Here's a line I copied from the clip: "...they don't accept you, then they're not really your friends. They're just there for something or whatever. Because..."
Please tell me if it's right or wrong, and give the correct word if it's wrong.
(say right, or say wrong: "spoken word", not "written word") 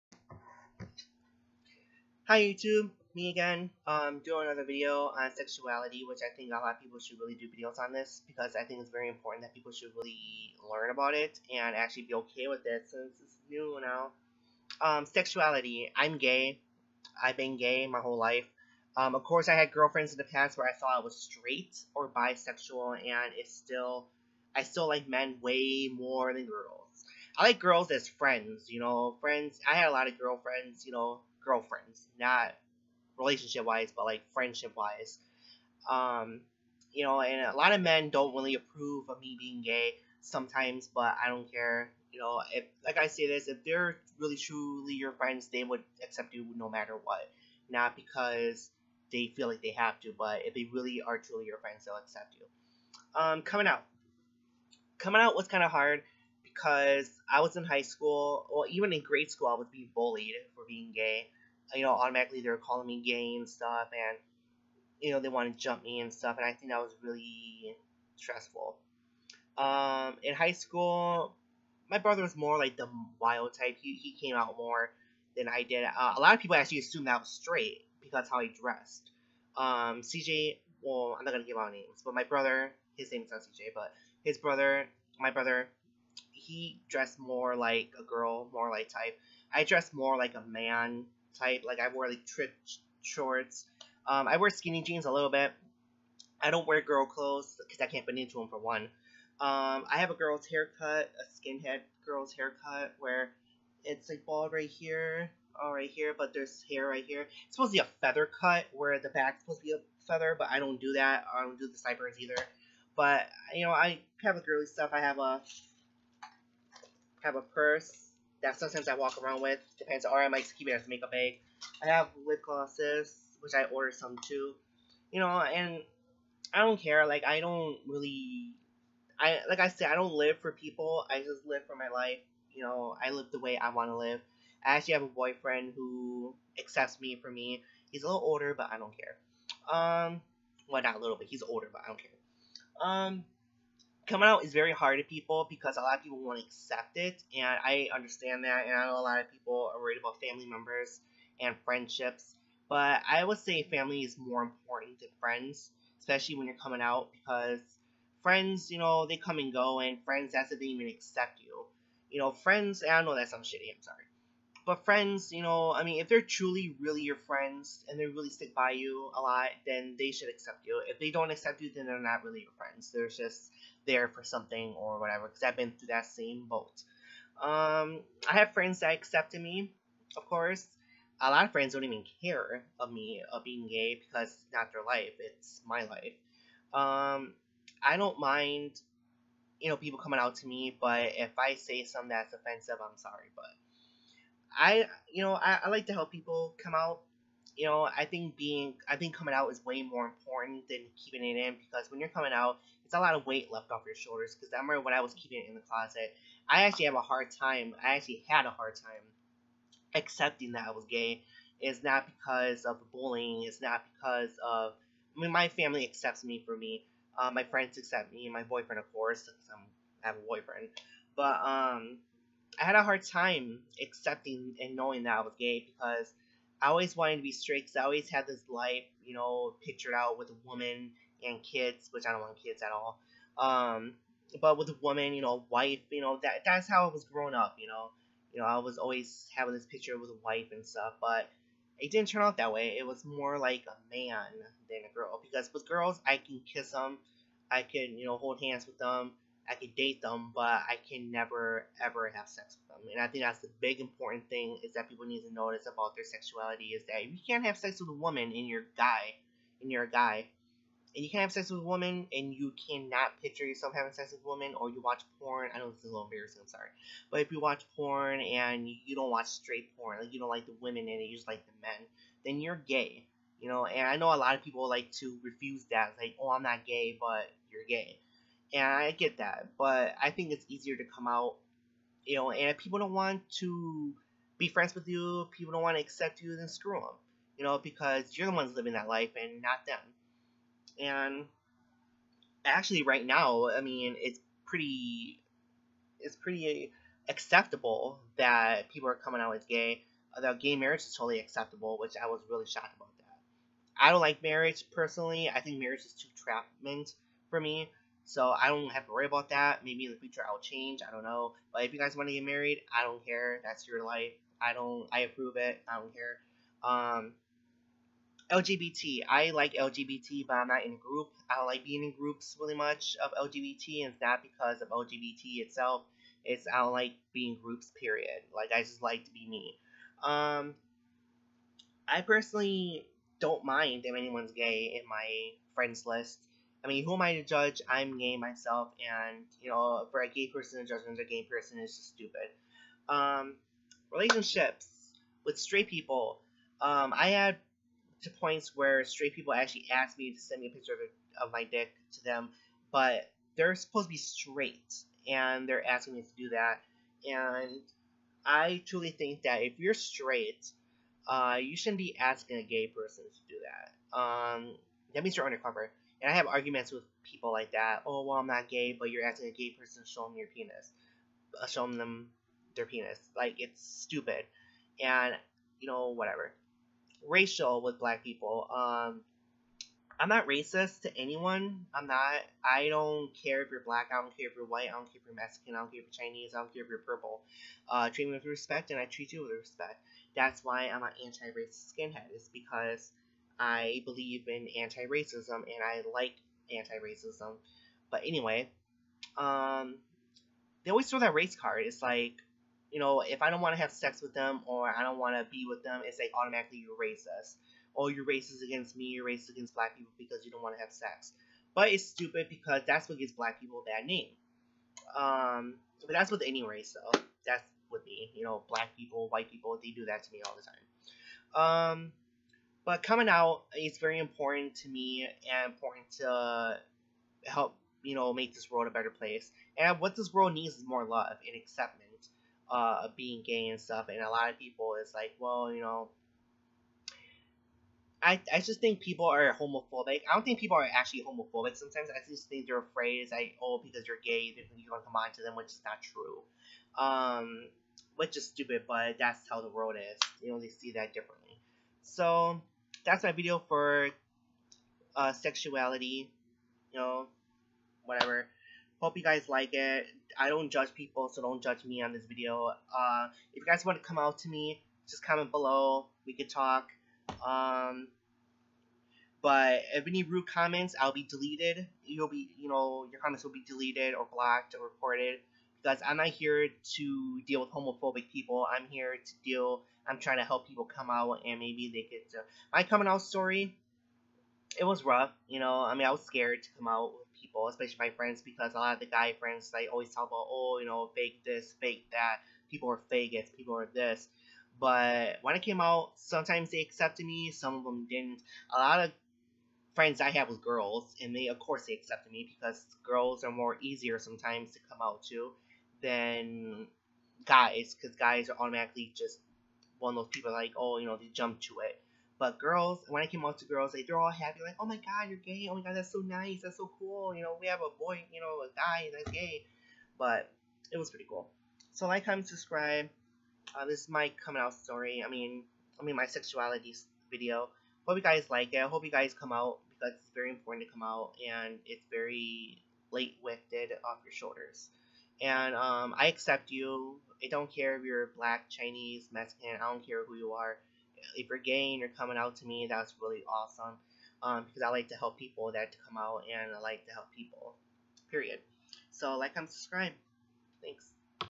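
right.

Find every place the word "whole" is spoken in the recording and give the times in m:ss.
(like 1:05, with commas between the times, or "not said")
0:17.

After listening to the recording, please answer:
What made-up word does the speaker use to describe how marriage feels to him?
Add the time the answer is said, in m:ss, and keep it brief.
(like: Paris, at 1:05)
trapment, at 5:06.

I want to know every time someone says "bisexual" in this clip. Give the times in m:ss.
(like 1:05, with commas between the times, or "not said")
0:22.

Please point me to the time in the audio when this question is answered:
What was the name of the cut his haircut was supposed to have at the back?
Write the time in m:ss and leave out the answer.
1:48.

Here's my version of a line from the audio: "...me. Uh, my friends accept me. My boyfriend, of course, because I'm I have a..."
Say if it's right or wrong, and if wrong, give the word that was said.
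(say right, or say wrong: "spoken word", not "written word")
right.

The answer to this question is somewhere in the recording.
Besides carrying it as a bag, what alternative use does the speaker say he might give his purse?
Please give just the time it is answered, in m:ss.
2:00.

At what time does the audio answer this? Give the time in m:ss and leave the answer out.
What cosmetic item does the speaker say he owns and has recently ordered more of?
2:02.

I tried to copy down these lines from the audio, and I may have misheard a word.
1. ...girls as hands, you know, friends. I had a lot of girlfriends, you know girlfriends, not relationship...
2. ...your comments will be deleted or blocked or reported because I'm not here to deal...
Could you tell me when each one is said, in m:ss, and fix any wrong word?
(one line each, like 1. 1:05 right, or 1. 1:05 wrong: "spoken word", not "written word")
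1. 0:27 wrong: "friends", not "hands"
2. 7:52 right.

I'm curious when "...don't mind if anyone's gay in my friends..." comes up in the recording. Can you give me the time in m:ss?
5:33.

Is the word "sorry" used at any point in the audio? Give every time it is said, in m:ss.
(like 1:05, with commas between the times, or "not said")
2:43, 3:12, 4:26.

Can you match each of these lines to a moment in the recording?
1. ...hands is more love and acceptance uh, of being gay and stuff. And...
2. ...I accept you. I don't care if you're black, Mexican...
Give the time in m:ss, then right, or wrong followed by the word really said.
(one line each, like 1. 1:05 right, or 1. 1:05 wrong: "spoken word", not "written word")
1. 7:10 wrong: "needs", not "hands"
2. 8:55 wrong: "Chinese", not "Mexican".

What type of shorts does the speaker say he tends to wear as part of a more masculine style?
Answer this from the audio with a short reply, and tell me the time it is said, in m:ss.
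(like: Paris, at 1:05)
trip shorts, at 1:32.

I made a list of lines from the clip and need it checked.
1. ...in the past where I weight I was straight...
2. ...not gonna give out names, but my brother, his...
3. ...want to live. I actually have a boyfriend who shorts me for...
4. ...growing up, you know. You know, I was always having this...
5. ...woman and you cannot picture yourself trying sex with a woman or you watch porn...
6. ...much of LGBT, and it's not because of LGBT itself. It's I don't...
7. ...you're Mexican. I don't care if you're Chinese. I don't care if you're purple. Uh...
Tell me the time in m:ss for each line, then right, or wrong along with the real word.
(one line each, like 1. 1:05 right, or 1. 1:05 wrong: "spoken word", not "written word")
1. 0:20 wrong: "thought", not "weight"
2. 1:21 right
3. 2:13 wrong: "accepts", not "shorts"
4. 3:57 right
5. 4:21 wrong: "having", not "trying"
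6. 5:22 right
7. 6:25 right.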